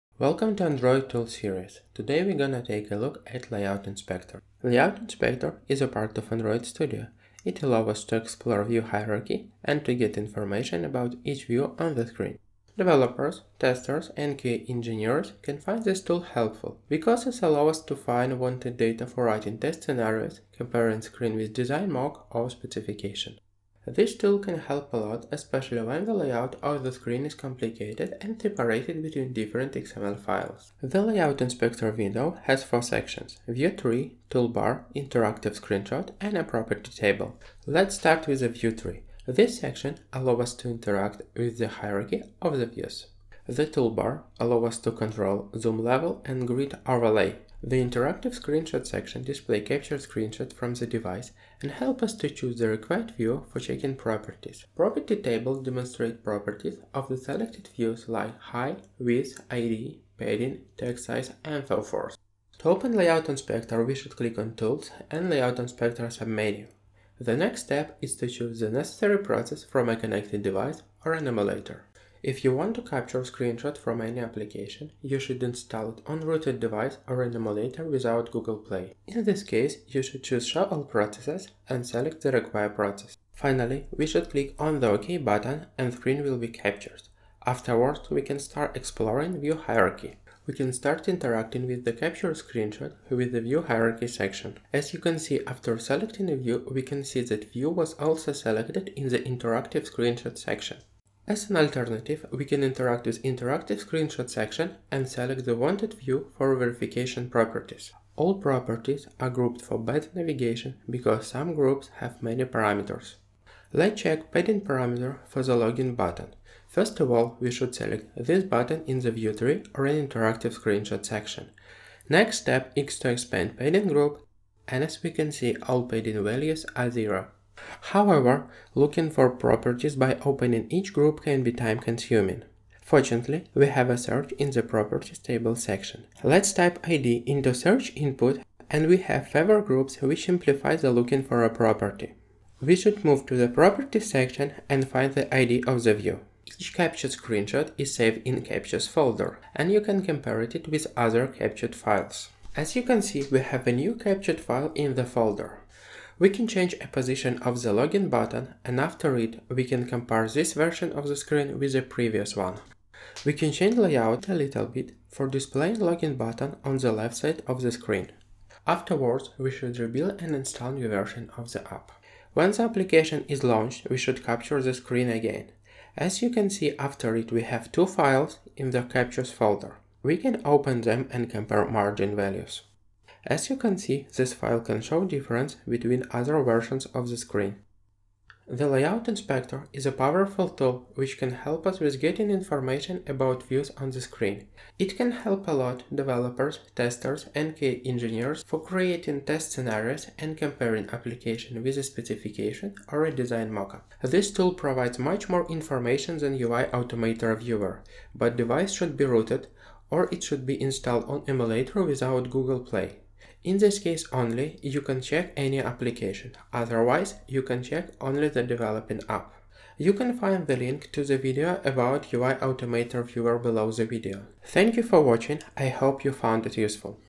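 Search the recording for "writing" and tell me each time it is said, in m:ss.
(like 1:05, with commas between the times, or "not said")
0:19.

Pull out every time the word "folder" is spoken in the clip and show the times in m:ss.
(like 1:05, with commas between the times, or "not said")
2:28, 2:35, 2:59.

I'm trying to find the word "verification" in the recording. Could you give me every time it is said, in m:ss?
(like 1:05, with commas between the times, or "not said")
1:46.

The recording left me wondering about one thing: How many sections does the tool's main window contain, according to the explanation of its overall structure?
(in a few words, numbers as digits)
4.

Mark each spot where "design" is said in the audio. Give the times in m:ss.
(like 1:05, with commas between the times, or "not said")
0:21, 3:23.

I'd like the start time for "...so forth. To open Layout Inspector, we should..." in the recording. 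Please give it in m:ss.
1:01.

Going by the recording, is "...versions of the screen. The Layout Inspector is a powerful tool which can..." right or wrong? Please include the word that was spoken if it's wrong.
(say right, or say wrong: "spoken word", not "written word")
right.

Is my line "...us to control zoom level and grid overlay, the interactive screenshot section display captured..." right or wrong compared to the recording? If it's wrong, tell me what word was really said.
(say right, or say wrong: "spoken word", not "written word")
right.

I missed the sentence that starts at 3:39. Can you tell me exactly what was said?
You can find the link to the video about UI Automator Viewer below the video.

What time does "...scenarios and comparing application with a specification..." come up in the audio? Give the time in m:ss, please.
3:19.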